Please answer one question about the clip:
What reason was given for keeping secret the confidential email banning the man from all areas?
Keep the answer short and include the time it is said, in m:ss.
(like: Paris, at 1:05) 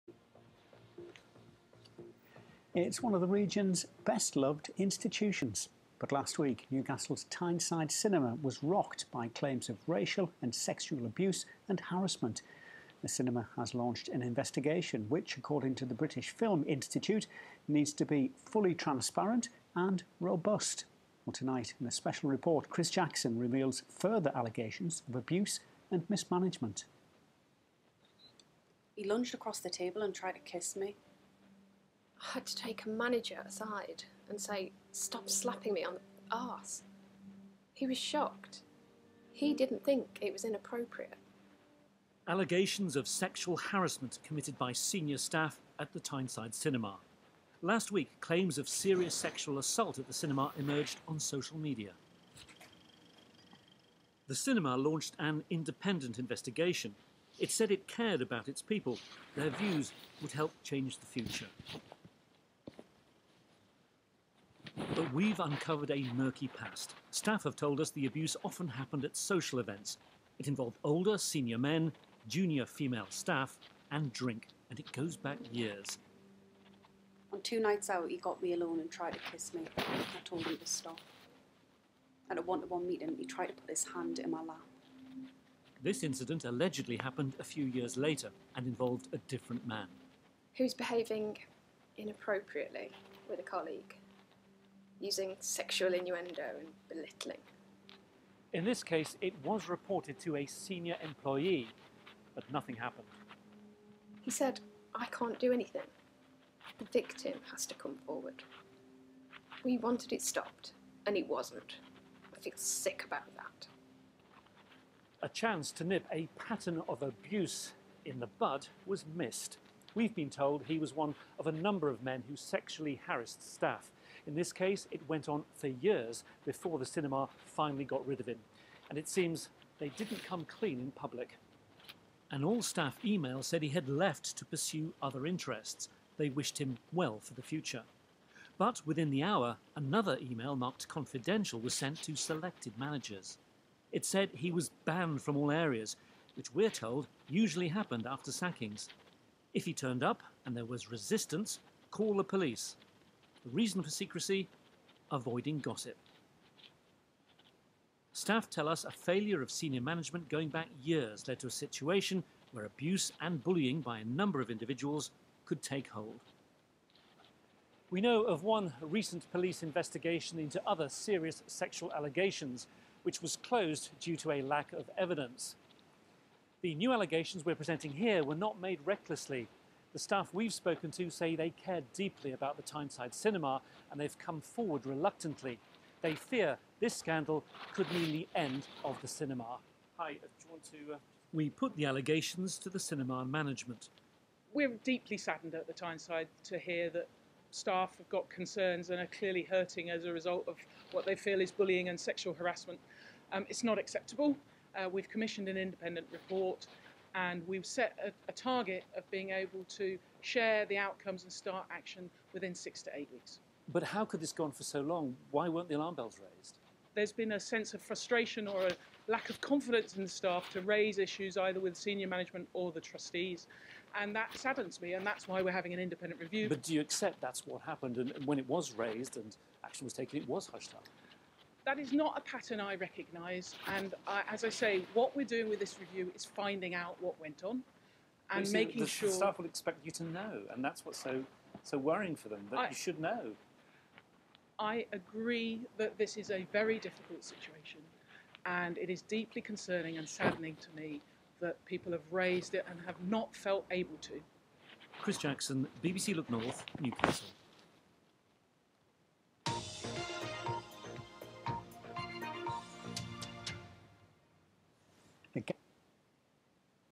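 Avoiding gossip, at 2:35.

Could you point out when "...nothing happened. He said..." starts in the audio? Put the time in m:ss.
1:42.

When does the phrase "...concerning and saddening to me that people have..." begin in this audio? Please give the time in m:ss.
4:09.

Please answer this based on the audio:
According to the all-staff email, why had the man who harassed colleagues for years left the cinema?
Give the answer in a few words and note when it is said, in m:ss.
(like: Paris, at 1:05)
To pursue other interests, at 2:14.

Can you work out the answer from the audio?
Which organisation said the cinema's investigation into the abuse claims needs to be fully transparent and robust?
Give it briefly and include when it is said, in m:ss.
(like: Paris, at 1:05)
British Film Institute, at 0:15.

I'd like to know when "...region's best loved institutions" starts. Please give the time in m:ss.
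0:03.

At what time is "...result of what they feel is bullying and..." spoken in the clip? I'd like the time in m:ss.
3:20.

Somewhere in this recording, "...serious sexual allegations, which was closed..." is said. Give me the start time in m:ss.
2:50.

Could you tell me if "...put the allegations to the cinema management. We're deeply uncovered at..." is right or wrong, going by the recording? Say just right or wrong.
wrong.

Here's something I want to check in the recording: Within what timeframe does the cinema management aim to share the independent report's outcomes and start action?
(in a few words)
6 to 8 weeks.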